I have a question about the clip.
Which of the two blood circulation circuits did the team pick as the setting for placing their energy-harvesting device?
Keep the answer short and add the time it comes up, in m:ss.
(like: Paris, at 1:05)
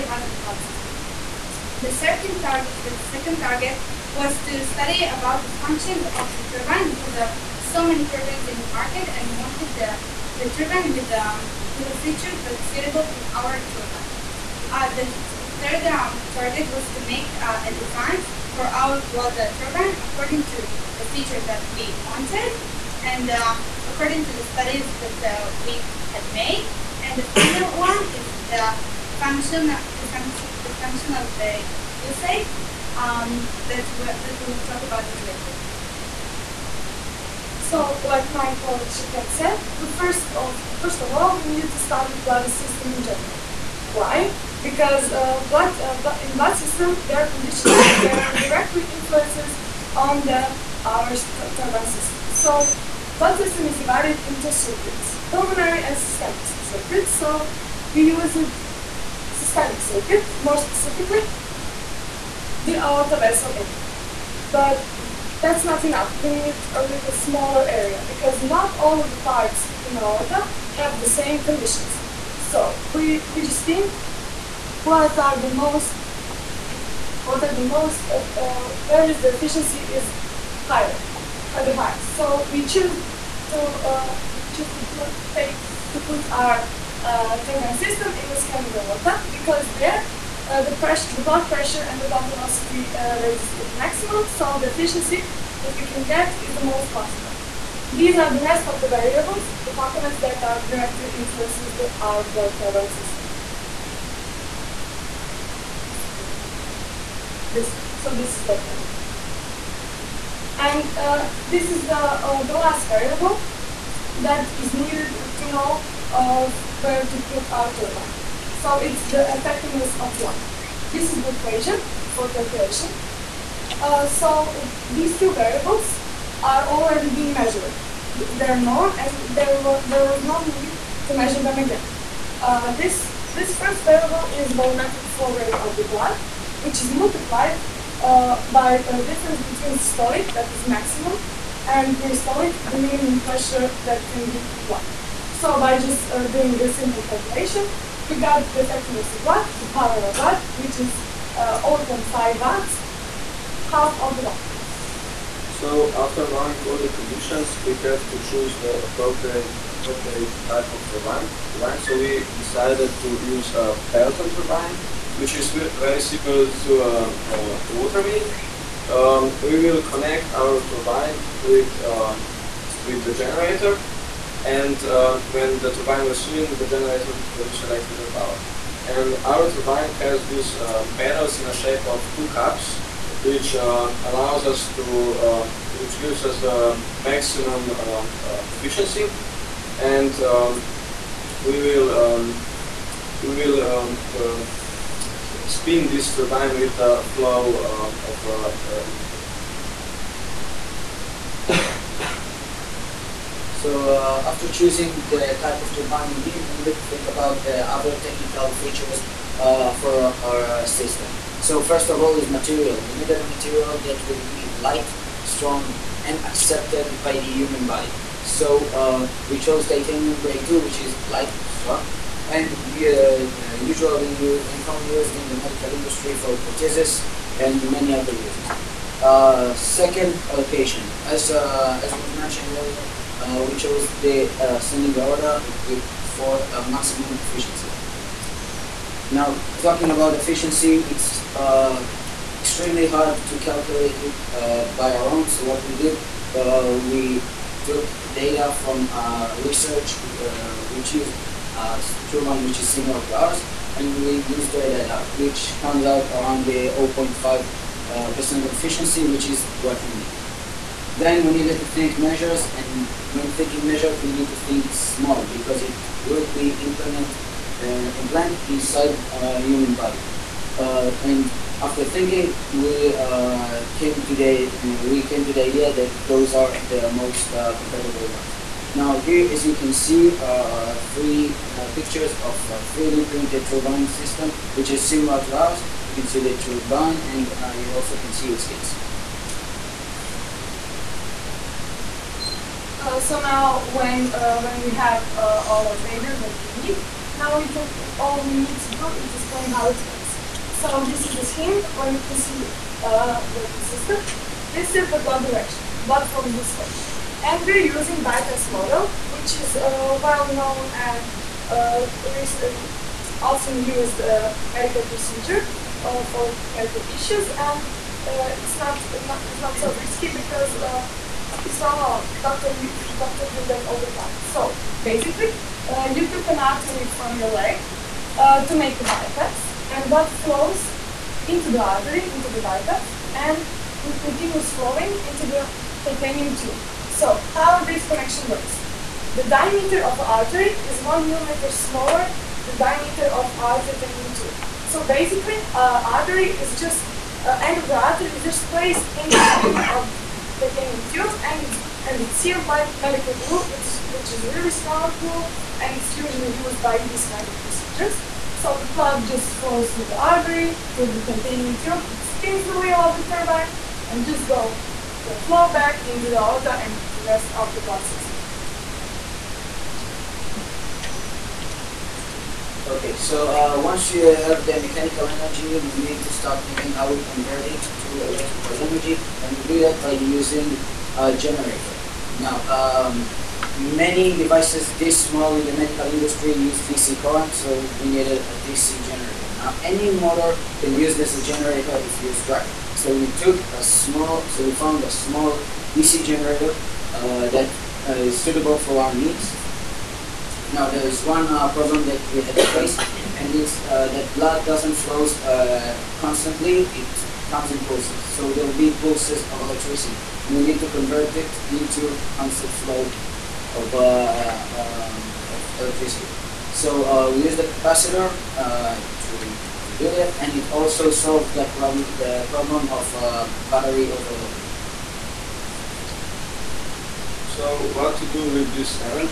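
Systemic circuit, at 0:59.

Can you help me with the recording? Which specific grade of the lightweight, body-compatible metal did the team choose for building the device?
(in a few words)
Titanium grade 2.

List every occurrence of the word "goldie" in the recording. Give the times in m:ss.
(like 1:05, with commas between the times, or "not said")
not said.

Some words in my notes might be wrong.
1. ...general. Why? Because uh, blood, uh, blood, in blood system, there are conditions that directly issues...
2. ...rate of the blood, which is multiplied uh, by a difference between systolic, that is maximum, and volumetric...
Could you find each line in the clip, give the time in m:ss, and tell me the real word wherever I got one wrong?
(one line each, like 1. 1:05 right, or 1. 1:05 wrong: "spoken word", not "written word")
1. 0:43 wrong: "influences", not "issues"
2. 2:15 wrong: "diastolic", not "volumetric".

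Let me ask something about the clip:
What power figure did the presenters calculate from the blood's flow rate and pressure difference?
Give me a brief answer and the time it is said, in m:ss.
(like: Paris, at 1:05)
0.5 watts, at 2:31.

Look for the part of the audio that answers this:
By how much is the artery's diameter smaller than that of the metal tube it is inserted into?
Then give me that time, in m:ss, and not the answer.
5:40.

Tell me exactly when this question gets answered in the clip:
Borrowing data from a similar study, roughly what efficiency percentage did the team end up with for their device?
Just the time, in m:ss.
4:16.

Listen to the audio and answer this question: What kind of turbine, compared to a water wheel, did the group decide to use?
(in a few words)
Pelton turbine.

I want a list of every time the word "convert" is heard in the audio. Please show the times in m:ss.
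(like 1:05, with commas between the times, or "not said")
6:17, 6:50.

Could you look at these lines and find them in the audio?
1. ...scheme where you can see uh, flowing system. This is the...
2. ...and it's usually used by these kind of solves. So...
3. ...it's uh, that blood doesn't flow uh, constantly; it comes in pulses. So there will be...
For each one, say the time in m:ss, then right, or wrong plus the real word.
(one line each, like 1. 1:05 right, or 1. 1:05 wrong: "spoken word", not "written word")
1. 5:01 wrong: "working", not "flowing"
2. 5:55 wrong: "procedures", not "solves"
3. 6:43 right.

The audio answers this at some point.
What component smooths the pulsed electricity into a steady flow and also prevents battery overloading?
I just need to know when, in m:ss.
6:57.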